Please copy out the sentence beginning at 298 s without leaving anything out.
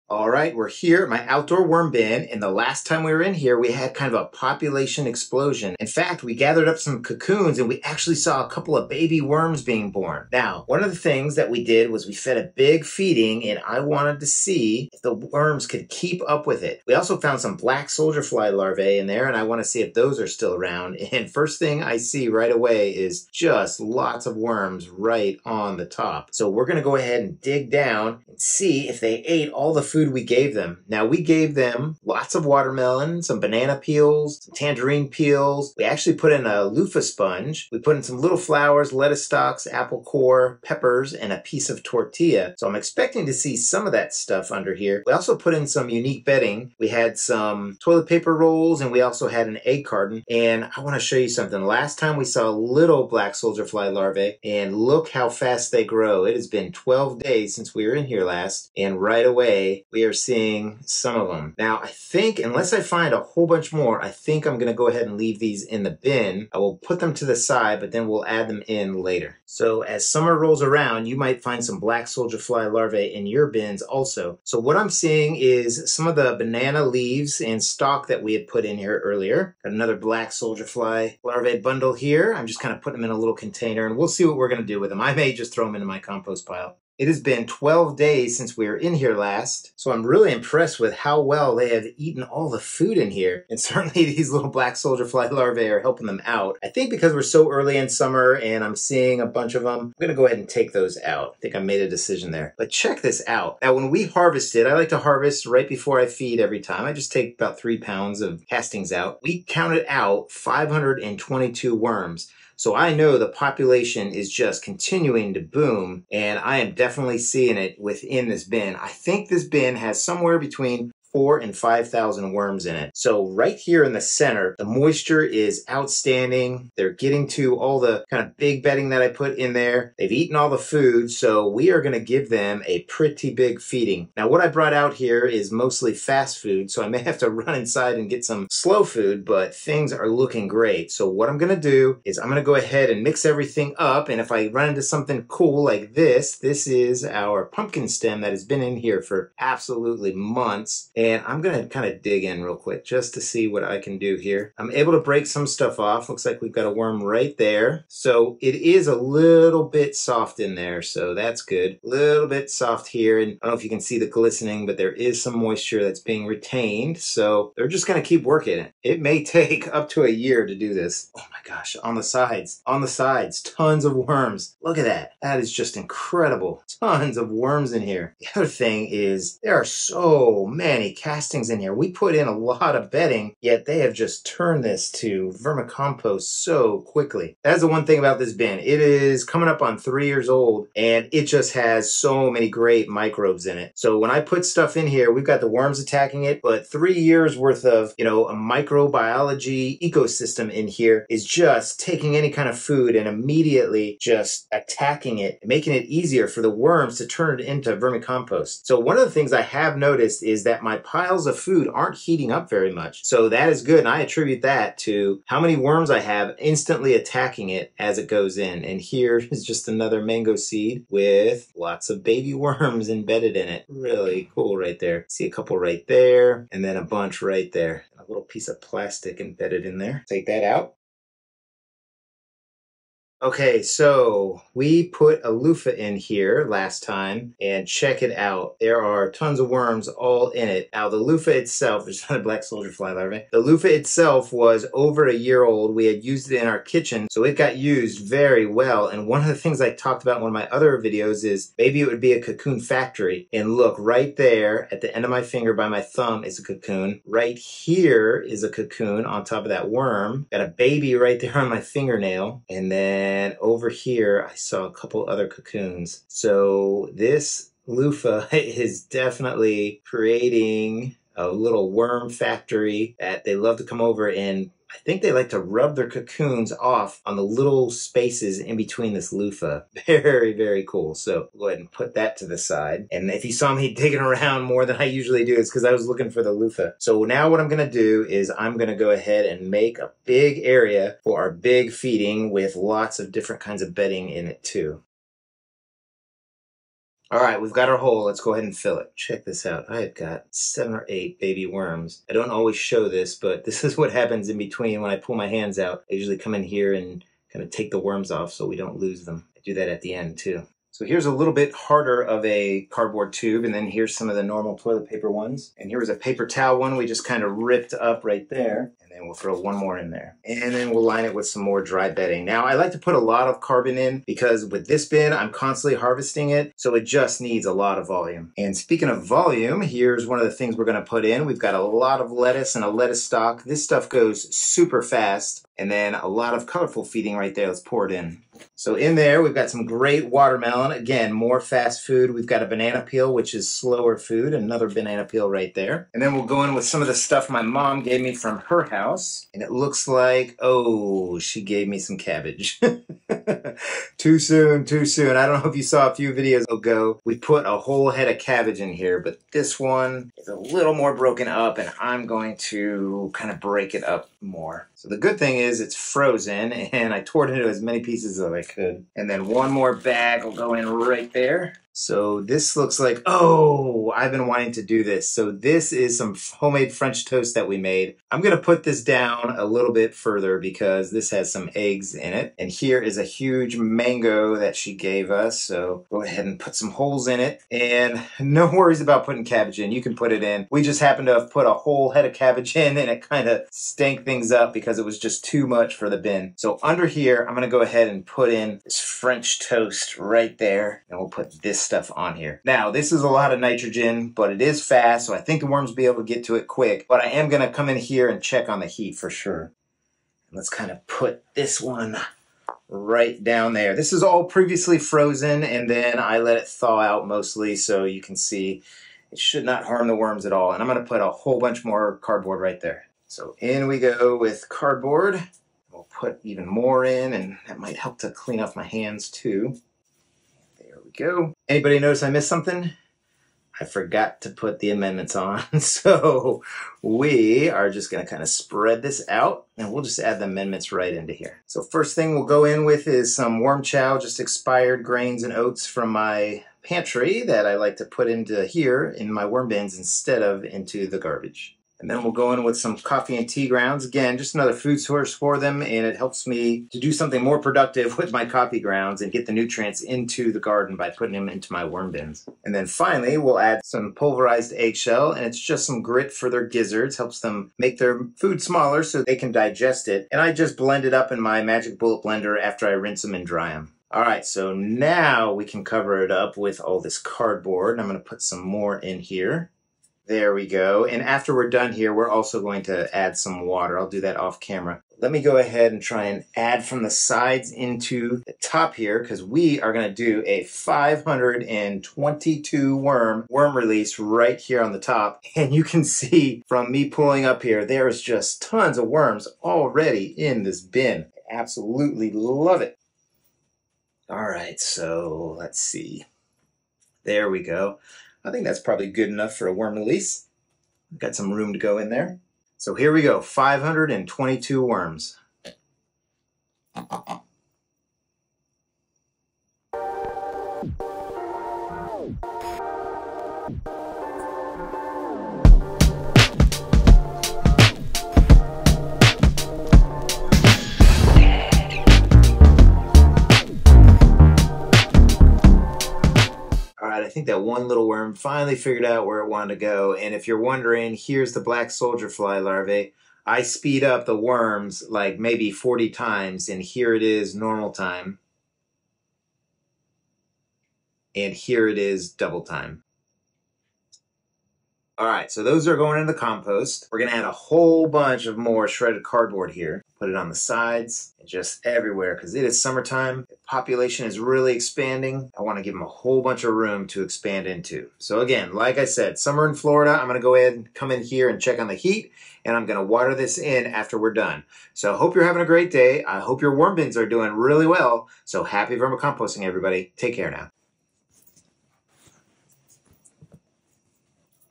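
Let's go ahead and fill it.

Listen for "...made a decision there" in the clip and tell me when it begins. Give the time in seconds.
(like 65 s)
101 s.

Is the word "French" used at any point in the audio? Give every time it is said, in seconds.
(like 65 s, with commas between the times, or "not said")
376 s, 398 s.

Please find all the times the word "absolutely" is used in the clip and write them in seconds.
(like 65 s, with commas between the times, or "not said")
149 s, 501 s.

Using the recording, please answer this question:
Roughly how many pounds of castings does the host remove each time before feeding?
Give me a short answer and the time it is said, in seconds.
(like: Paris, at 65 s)
3 pounds, at 107 s.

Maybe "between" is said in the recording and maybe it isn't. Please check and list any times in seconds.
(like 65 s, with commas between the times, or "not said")
120 s, 278 s, 304 s.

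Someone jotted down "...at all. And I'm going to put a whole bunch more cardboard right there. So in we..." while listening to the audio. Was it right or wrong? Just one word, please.
right.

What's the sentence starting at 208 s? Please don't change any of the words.
So one of the things I have noticed is that my piles of food aren't heating up very much.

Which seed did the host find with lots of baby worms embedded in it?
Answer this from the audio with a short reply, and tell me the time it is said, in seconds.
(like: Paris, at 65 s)
Mango seed, at 220 s.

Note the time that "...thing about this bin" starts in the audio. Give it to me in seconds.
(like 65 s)
187 s.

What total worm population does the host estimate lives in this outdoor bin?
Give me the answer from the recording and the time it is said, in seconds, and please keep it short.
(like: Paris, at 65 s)
4,000 to 5,000, at 120 s.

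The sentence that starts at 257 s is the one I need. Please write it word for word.
Right here is a cocoon on top of that worm.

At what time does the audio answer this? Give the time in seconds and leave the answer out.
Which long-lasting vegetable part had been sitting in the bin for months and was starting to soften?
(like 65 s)
147 s.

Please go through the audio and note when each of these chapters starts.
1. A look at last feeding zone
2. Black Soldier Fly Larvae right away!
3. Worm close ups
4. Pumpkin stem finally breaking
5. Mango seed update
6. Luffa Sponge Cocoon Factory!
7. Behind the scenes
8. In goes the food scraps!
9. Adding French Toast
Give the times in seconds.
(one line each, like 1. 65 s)
1. 31 s
2. 52 s
3. 104 s
4. 144 s
5. 213 s
6. 232 s
7. 299 s
8. 329 s
9. 373 s.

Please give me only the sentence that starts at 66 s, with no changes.
I will put them to the side, but then we'll add them in later.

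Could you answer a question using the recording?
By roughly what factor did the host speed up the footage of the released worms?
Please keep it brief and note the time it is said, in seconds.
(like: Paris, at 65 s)
40 times, at 545 s.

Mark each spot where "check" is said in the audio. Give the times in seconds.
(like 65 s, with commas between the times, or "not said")
102 s, 237 s, 298 s, 408 s, 571 s.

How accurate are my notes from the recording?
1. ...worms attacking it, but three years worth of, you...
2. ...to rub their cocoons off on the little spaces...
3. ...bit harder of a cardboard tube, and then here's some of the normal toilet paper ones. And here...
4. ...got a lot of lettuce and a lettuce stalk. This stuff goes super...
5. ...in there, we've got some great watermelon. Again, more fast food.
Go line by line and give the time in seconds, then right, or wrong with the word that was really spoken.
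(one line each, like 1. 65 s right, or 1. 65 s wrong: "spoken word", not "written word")
1. 195 s right
2. 275 s right
3. 311 s right
4. 331 s right
5. 338 s right.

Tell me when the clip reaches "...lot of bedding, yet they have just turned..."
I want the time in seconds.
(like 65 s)
182 s.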